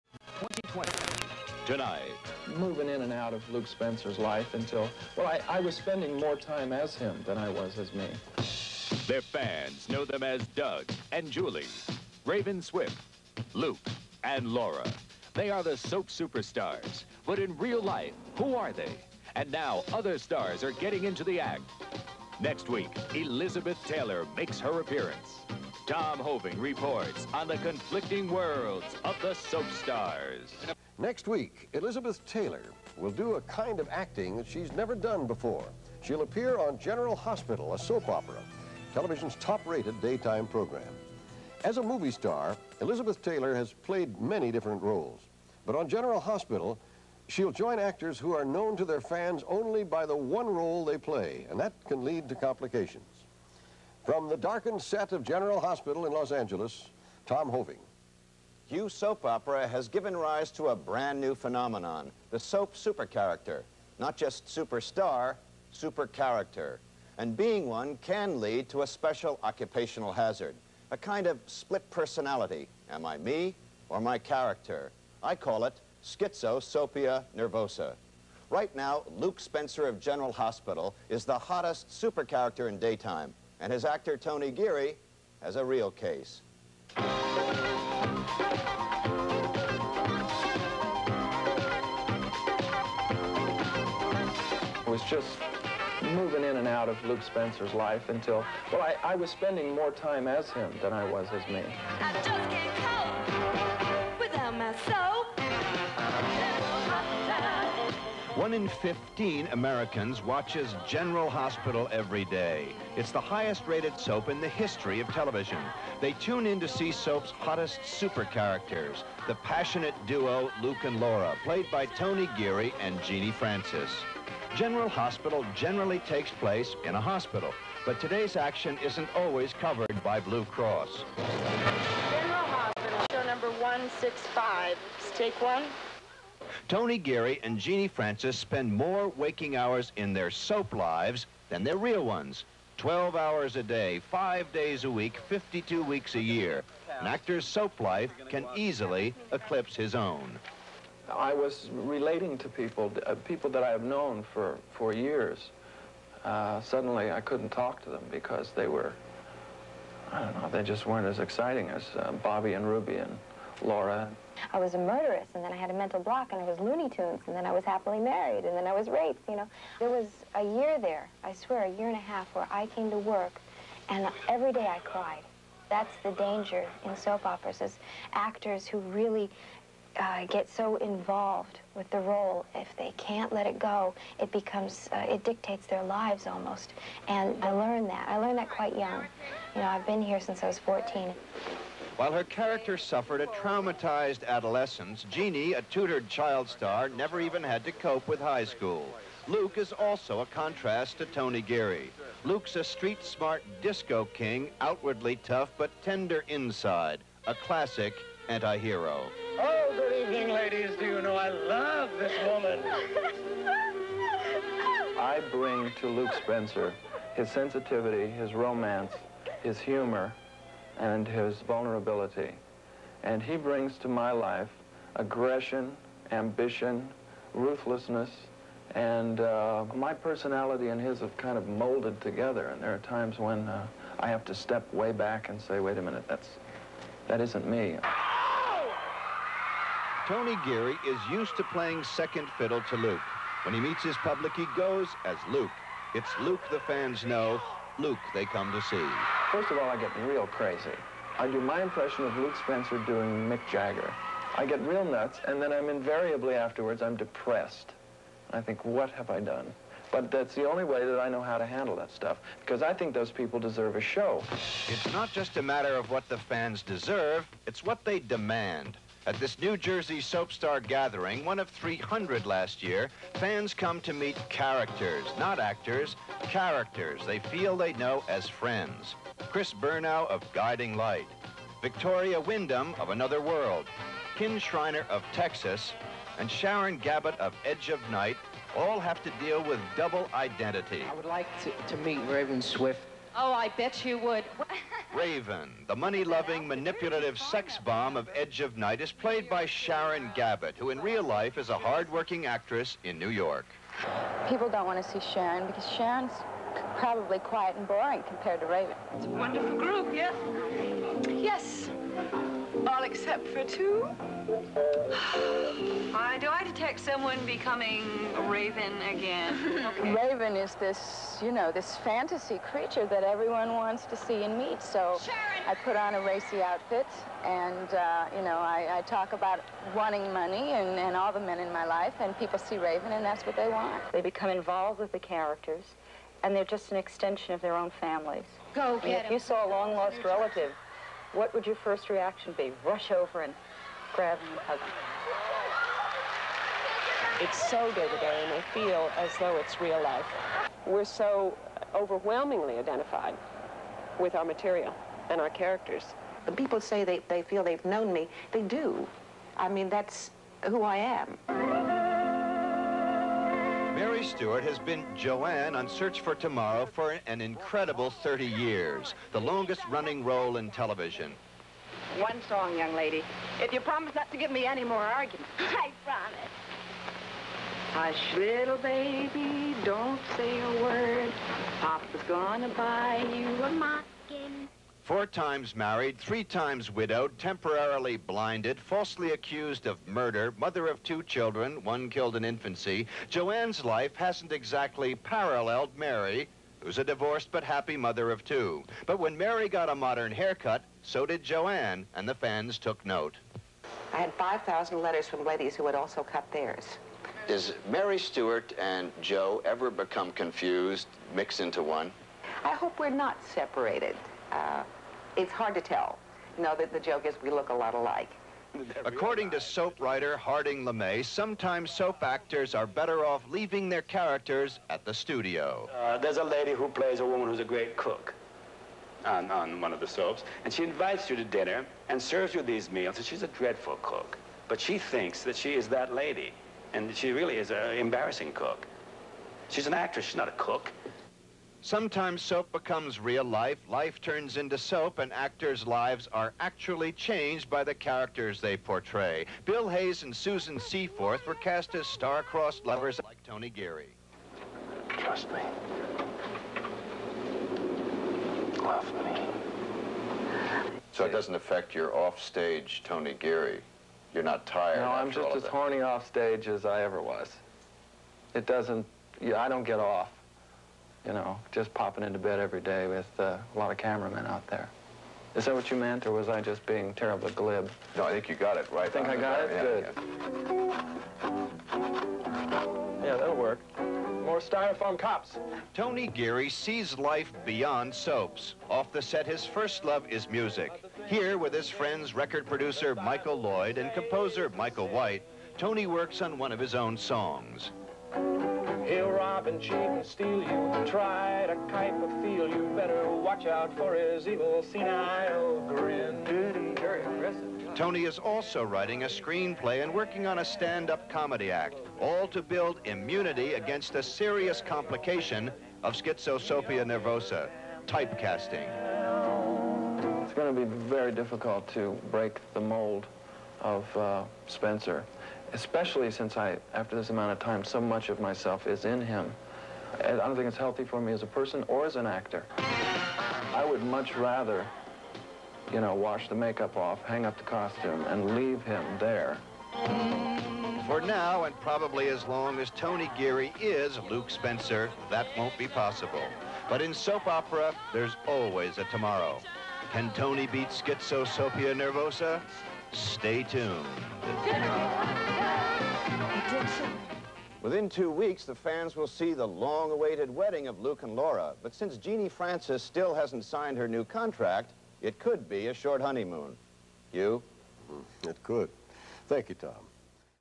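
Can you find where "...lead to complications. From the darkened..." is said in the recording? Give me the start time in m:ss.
0:52.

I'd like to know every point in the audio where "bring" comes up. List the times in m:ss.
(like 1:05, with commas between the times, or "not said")
3:35, 3:43.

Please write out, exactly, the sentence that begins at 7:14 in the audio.
But she thinks that she is that lady, and she really is an embarrassing cook.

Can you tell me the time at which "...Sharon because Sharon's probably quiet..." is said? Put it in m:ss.
5:05.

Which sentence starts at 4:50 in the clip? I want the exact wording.
I would like to, to meet Raven Swift.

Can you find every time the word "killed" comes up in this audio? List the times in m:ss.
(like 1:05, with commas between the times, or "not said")
6:31.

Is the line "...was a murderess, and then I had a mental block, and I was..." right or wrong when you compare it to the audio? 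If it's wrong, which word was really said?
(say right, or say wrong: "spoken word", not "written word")
right.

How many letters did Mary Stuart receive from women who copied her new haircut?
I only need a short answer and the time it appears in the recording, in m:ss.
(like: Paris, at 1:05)
5,000, at 6:44.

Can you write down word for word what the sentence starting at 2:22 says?
12 hours a day, 5 days a week, 52 weeks a year.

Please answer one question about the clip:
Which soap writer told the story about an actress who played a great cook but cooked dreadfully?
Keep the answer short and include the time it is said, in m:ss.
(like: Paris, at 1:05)
Harding LeMay, at 7:00.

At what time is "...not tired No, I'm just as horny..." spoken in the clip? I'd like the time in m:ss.
7:44.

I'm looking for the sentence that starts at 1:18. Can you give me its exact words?
Right now, Luke Spencer of General Hospital is the hottest super character in daytime.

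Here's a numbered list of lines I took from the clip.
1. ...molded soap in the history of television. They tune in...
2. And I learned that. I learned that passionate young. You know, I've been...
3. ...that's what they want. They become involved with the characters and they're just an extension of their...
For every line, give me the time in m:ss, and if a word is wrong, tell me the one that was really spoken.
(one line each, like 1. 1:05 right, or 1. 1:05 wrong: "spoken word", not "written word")
1. 1:53 wrong: "rated", not "molded"
2. 3:07 wrong: "quite", not "passionate"
3. 5:33 right.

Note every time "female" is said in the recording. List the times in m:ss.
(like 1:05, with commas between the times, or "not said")
not said.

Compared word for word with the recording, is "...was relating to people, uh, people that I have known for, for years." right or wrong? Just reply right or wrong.
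right.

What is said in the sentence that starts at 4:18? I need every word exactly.
I think, what have I done?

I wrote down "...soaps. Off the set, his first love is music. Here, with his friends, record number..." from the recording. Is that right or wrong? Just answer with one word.
wrong.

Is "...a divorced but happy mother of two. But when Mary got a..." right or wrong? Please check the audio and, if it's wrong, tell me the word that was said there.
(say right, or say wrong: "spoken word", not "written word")
right.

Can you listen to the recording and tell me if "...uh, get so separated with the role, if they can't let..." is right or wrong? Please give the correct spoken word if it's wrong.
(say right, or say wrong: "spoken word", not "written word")
wrong: "involved", not "separated".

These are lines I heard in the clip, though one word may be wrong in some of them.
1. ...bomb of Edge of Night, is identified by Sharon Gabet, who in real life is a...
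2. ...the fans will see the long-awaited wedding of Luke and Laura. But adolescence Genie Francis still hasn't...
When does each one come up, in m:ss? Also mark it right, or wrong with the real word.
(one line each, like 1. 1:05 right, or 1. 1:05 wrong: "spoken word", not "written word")
1. 4:57 wrong: "played", not "identified"
2. 9:18 wrong: "since", not "adolescence".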